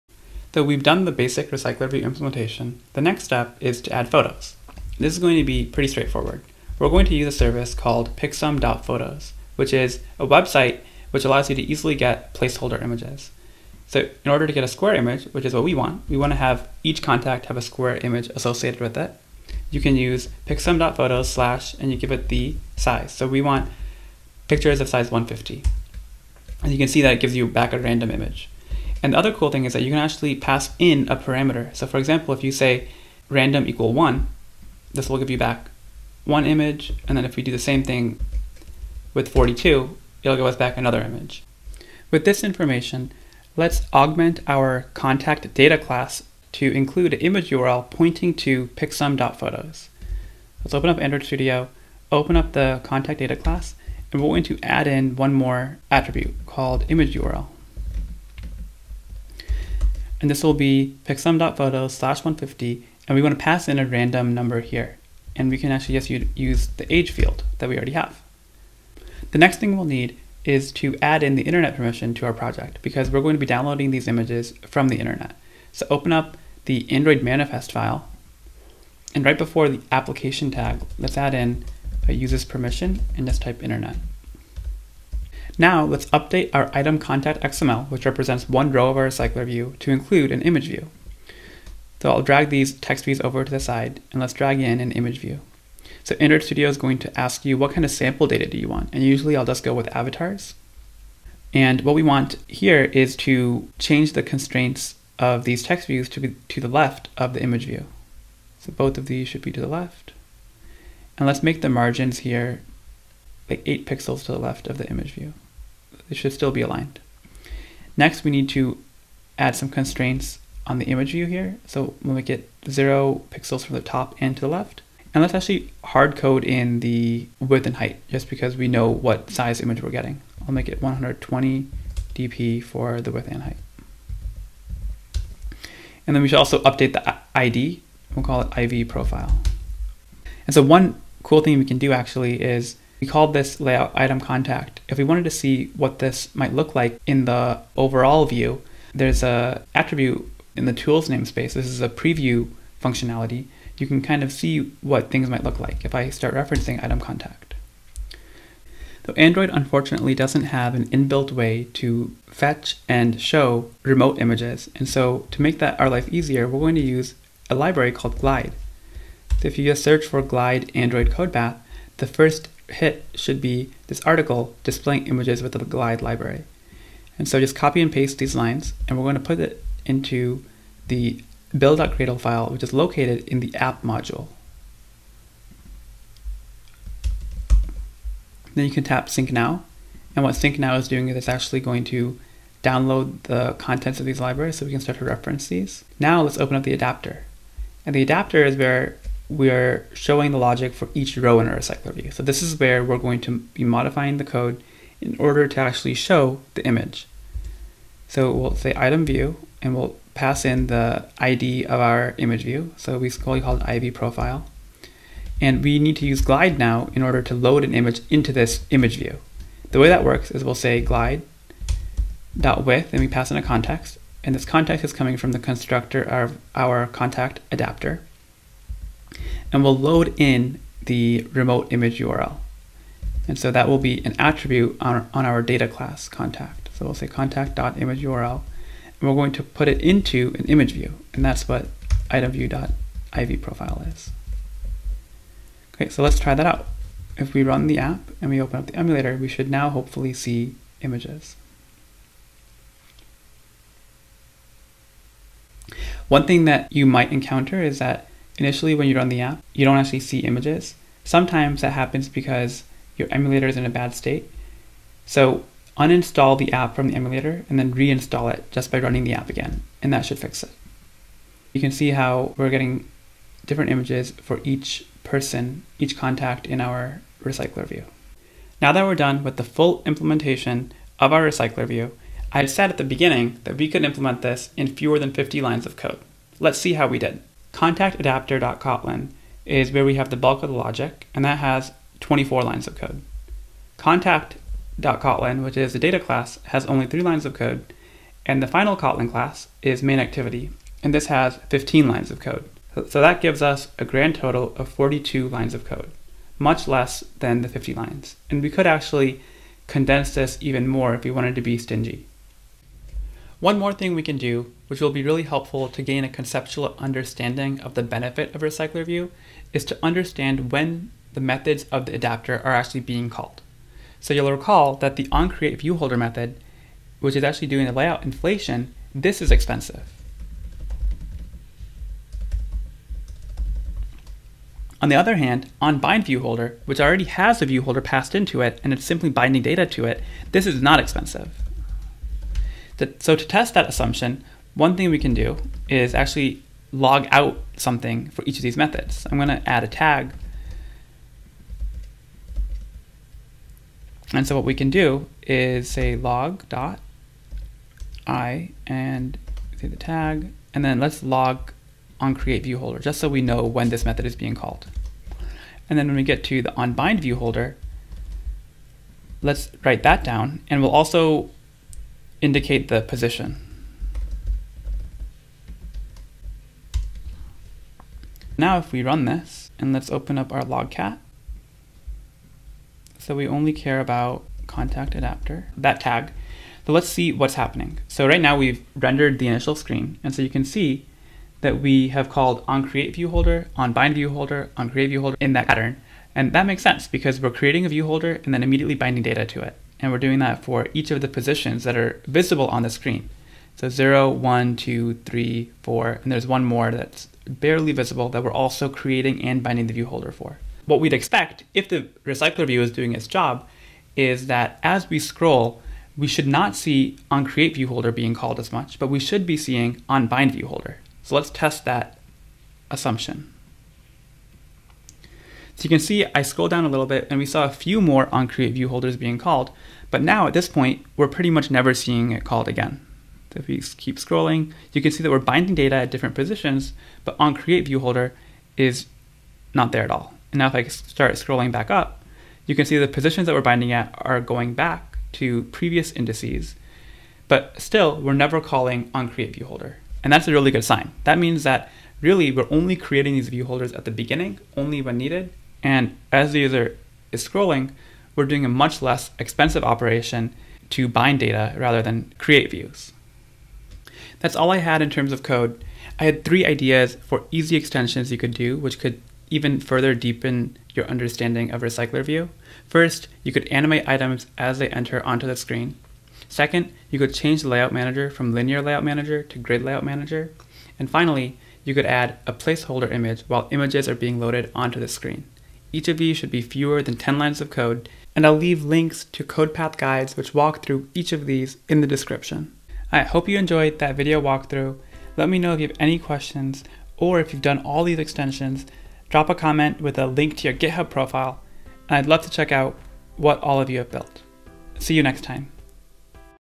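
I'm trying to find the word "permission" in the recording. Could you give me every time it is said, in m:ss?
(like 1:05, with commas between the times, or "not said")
1:11, 1:22.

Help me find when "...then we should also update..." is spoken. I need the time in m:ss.
2:16.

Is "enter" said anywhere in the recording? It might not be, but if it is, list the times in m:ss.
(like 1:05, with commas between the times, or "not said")
7:54.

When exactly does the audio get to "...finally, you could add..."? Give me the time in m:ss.
8:00.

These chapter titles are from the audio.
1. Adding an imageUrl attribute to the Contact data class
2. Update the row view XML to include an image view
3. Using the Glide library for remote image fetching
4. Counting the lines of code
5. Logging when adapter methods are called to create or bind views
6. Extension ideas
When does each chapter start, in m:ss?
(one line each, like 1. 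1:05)
1. 0:52
2. 1:26
3. 2:38
4. 4:38
5. 5:14
6. 7:44.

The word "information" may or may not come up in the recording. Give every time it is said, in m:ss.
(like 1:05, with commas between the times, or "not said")
0:42.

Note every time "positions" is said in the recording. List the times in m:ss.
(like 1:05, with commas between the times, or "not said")
6:12, 6:41, 7:16, 7:22.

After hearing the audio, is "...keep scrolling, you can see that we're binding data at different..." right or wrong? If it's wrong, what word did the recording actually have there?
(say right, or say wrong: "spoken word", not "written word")
right.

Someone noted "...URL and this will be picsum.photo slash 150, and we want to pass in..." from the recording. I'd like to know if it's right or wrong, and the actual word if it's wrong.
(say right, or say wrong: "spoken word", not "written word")
right.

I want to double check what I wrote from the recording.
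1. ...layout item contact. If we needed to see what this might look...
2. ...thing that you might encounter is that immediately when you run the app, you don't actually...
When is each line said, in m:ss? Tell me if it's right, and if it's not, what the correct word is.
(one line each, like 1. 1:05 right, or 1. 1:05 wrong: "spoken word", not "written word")
1. 2:23 wrong: "wanted", not "needed"
2. 4:16 wrong: "initially", not "immediately".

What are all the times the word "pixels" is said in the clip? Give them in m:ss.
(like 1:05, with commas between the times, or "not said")
1:53, 2:03.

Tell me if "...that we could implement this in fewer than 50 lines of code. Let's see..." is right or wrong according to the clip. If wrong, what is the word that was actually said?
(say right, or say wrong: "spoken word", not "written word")
right.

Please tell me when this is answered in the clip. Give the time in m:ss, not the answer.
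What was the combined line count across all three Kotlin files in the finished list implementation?
5:04.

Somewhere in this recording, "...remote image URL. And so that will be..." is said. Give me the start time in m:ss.
3:51.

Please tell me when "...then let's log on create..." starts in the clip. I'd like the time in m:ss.
6:00.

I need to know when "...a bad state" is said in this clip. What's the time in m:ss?
4:23.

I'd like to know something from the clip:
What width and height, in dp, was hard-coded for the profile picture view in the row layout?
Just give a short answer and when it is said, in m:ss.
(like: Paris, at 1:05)
120 dp, at 2:10.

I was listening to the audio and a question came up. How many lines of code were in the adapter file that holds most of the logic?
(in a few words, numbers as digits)
24.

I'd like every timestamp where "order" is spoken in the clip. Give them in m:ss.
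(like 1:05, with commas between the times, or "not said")
0:14, 3:25, 3:37.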